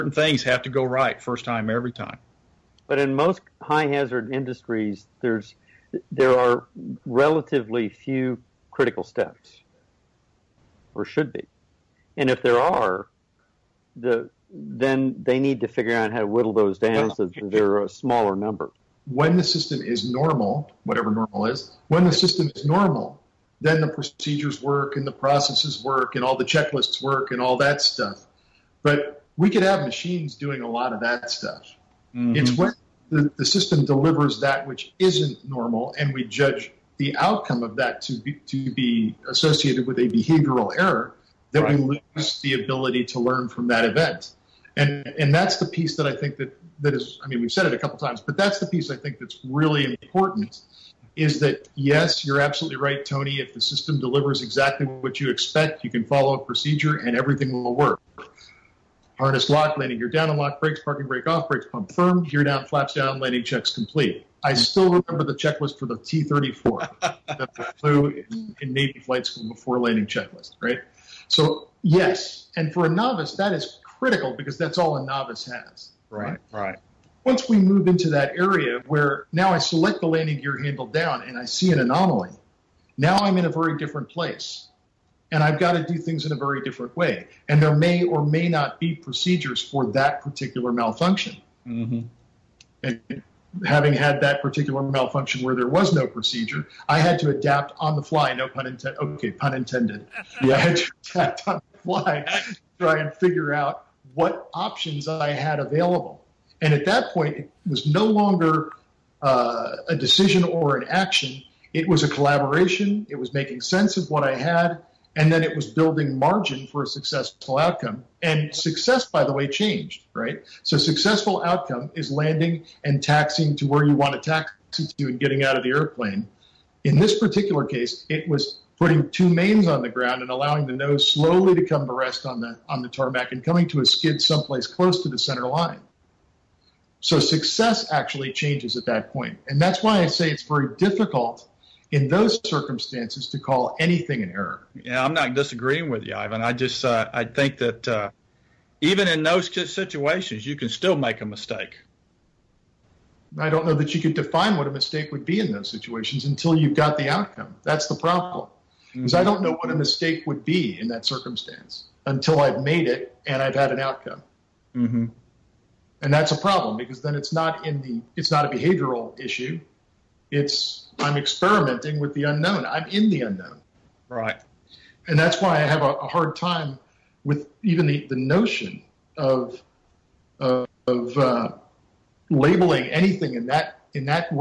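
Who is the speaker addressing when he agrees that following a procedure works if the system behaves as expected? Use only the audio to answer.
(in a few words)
Tony.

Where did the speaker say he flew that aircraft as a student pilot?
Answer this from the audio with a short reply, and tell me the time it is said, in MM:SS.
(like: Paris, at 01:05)
Navy flight school, at 01:08.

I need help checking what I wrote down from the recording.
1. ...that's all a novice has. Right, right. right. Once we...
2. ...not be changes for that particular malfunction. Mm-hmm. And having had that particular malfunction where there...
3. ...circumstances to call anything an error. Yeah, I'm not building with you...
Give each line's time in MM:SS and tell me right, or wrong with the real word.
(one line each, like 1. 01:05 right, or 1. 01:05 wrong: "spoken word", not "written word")
1. 01:14 right
2. 01:28 wrong: "procedures", not "changes"
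3. 02:22 wrong: "disagreeing", not "building".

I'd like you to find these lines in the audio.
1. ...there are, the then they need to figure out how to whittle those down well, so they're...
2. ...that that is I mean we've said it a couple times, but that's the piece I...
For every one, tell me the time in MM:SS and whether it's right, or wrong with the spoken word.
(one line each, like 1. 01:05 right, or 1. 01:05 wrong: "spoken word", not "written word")
1. 00:12 right
2. 00:46 right.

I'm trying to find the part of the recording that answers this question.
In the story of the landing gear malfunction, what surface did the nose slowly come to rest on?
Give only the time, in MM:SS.
02:12.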